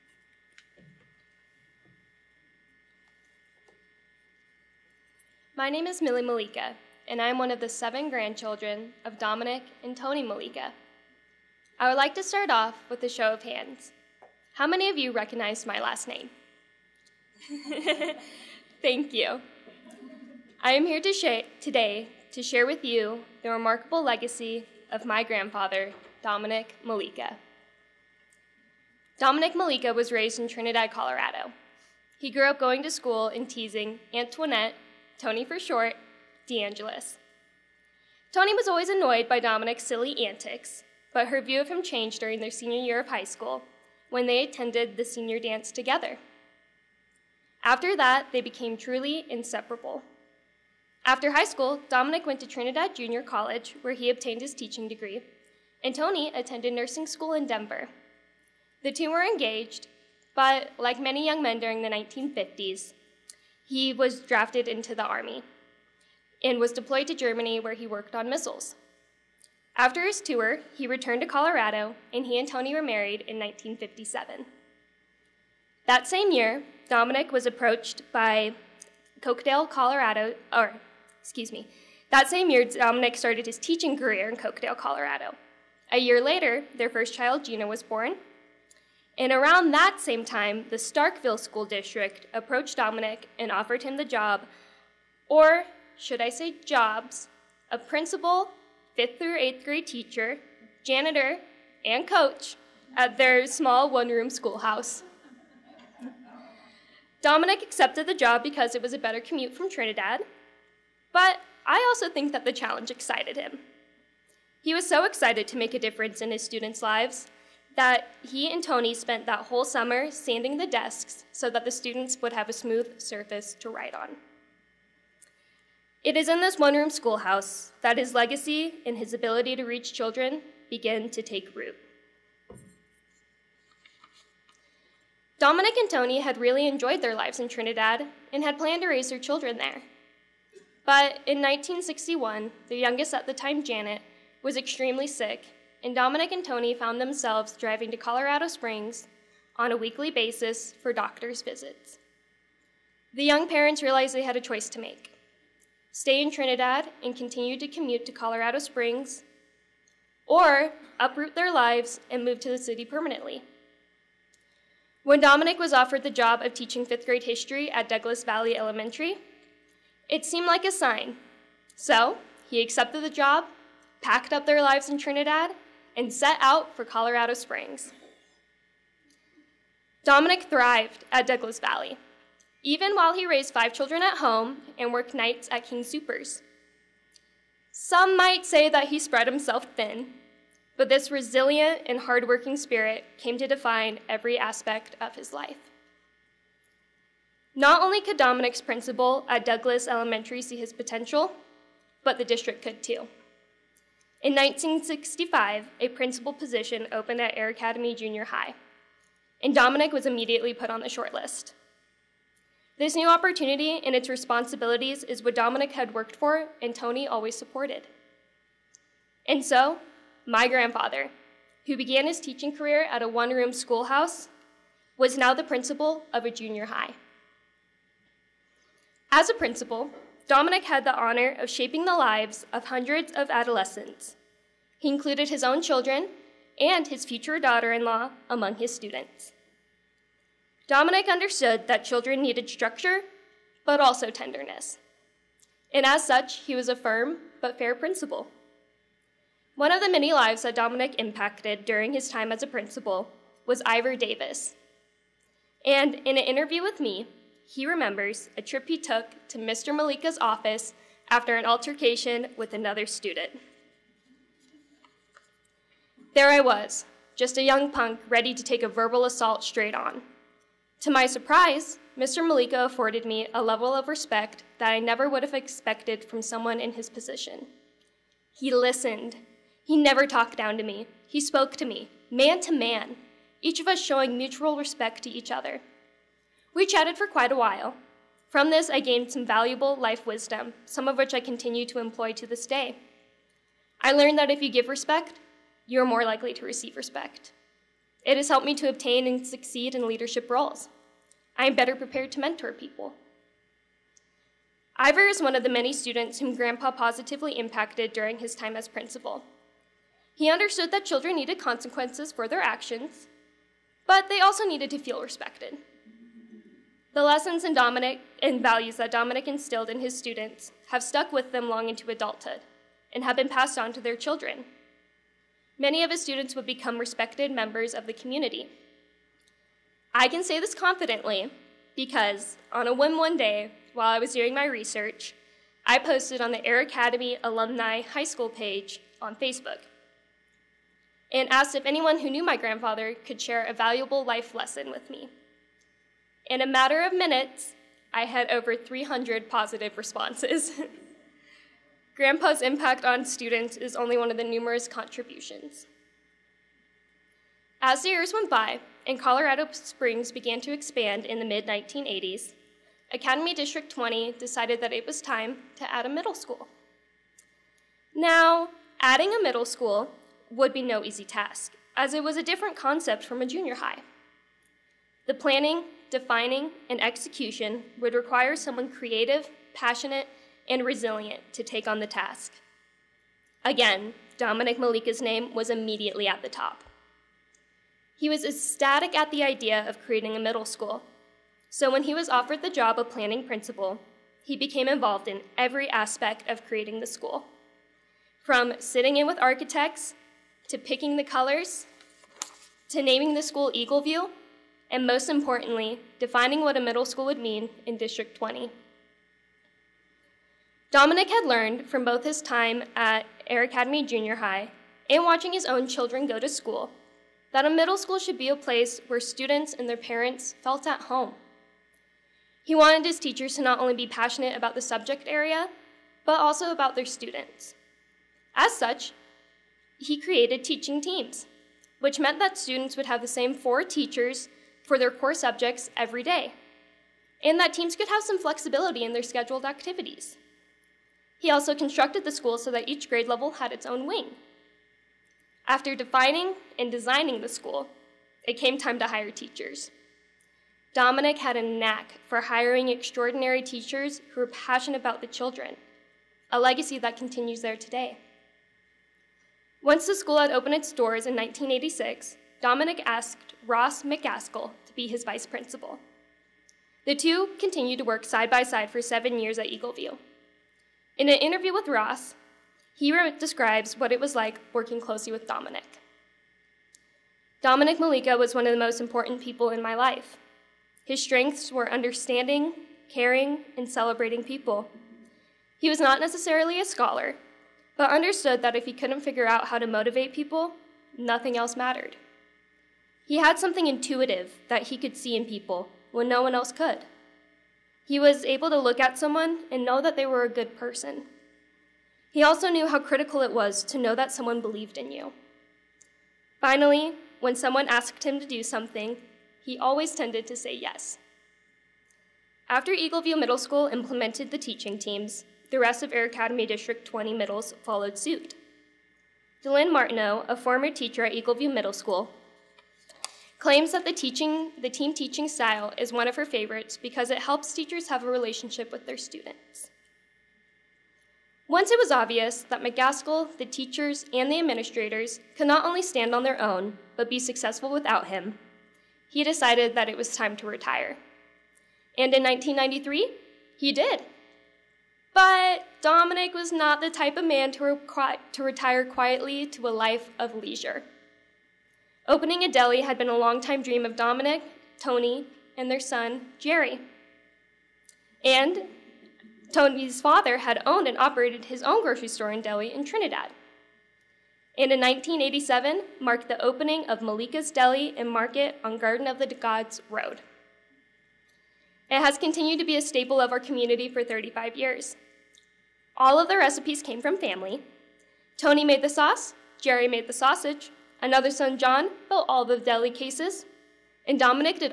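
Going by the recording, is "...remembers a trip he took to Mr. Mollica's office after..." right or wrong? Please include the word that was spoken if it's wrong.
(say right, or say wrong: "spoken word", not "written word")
right.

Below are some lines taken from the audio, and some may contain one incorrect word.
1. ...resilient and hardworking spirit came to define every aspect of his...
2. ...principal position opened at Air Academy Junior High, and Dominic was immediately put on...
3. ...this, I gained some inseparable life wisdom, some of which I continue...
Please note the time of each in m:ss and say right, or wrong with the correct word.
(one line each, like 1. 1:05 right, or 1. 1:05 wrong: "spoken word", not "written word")
1. 3:11 right
2. 3:25 right
3. 4:48 wrong: "valuable", not "inseparable".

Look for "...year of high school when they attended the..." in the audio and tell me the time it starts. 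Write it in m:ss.
0:42.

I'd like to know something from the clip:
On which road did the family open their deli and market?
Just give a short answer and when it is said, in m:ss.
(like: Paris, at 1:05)
Garden of the Gods Road, at 9:28.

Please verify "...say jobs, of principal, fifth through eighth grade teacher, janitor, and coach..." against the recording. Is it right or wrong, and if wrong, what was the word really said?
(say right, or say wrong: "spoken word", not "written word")
right.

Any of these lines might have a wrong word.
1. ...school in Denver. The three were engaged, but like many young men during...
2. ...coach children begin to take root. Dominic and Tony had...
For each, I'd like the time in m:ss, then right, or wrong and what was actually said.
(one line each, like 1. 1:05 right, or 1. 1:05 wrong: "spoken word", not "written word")
1. 0:57 wrong: "two", not "three"
2. 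2:09 wrong: "reach", not "coach".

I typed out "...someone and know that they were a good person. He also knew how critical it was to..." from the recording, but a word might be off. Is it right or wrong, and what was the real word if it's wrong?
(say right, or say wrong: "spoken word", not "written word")
right.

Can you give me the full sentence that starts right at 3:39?
And so, my grandfather, who began his teaching career at a one room schoolhouse, was now the principal of a junior high.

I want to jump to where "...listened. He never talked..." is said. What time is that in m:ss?
4:38.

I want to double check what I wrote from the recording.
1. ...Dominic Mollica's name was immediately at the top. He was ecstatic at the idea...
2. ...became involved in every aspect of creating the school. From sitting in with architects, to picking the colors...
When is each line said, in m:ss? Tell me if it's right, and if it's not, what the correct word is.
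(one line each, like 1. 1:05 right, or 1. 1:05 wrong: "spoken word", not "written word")
1. 6:24 right
2. 6:34 right.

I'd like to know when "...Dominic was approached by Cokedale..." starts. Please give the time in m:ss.
1:16.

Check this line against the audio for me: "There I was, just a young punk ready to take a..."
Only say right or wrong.
right.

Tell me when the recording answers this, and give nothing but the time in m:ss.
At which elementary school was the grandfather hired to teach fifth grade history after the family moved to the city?
2:47.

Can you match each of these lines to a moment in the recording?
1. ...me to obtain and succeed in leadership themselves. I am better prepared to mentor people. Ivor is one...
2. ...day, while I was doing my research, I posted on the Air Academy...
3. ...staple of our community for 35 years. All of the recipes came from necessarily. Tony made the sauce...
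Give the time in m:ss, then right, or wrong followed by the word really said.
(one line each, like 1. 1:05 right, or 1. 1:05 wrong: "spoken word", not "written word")
1. 4:58 wrong: "roles", not "themselves"
2. 5:33 right
3. 9:32 wrong: "family", not "necessarily".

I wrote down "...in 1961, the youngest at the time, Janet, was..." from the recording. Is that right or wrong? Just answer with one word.
right.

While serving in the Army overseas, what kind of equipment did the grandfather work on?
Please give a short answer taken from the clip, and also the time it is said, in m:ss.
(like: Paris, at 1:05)
Missiles, at 1:08.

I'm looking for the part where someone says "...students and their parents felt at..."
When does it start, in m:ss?
6:58.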